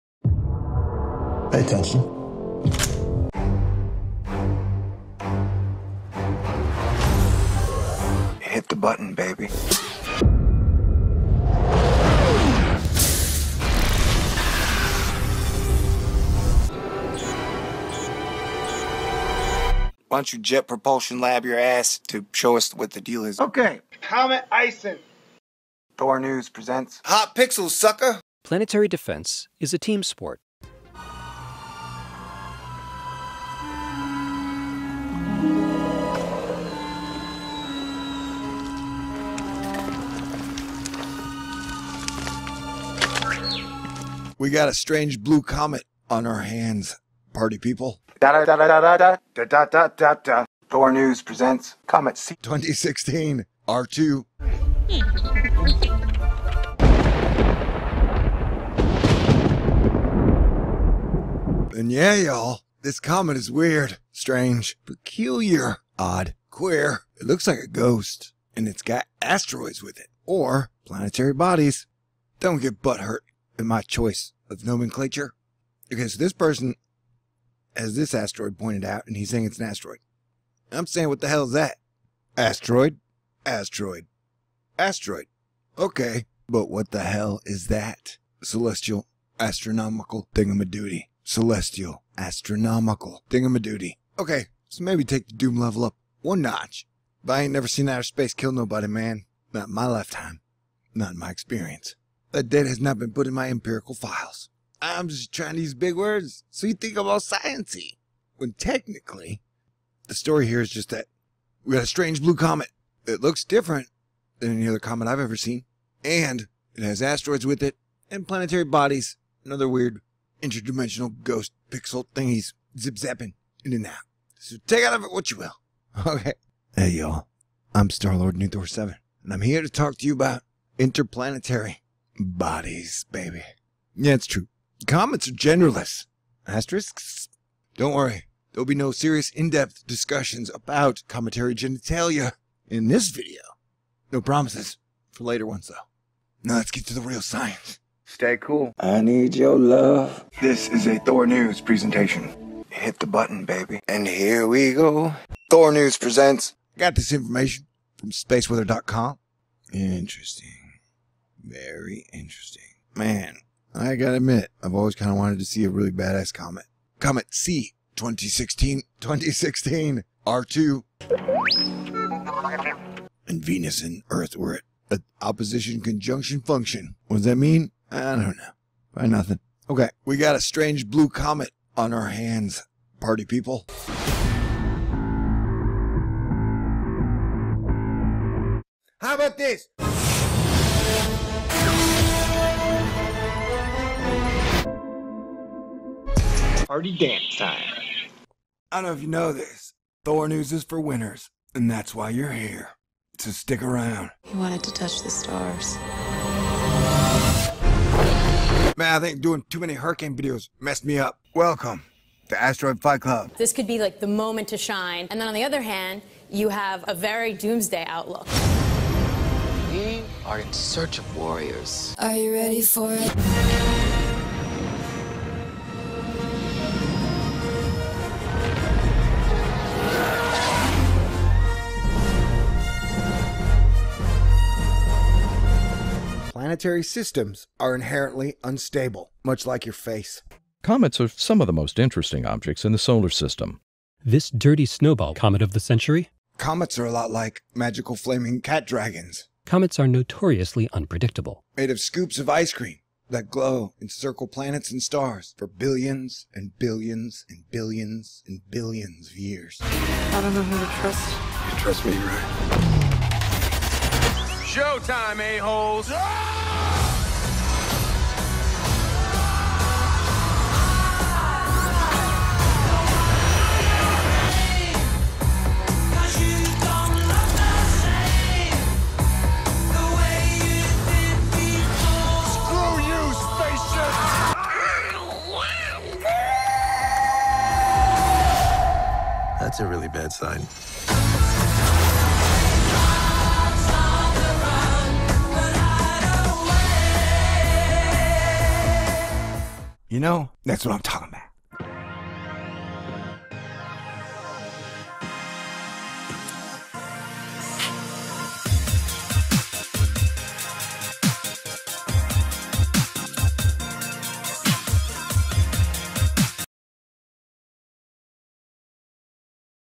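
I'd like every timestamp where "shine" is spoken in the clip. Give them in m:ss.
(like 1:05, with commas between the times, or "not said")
3:34.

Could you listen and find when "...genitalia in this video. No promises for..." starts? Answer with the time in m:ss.
2:21.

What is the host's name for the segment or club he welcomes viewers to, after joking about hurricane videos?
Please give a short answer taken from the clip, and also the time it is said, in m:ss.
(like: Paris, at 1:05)
Asteroid Fight Club, at 3:32.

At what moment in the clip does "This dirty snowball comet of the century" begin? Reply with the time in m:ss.
4:04.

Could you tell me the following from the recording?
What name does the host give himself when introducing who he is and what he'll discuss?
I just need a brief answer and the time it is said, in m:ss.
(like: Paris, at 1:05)
Star Lord New Thor Seven, at 2:07.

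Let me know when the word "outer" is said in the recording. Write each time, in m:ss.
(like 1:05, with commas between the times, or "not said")
1:37.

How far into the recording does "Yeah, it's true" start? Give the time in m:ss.
2:13.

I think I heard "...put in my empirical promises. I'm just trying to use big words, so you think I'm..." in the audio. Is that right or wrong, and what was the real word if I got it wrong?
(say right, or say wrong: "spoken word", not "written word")
wrong: "files", not "promises".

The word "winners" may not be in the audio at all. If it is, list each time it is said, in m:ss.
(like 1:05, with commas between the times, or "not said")
3:20.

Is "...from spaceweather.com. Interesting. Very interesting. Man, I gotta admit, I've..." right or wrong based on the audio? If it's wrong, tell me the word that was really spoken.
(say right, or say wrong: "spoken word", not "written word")
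right.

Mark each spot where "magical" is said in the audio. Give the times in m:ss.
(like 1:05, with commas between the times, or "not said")
4:07.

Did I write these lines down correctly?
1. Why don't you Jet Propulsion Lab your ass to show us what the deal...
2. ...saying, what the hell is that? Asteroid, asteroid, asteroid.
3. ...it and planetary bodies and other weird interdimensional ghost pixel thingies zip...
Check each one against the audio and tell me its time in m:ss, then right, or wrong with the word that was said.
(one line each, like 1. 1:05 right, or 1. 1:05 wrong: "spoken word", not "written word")
1. 0:20 right
2. 1:20 right
3. 1:57 right.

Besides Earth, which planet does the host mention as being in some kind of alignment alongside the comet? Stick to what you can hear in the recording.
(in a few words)
Venus.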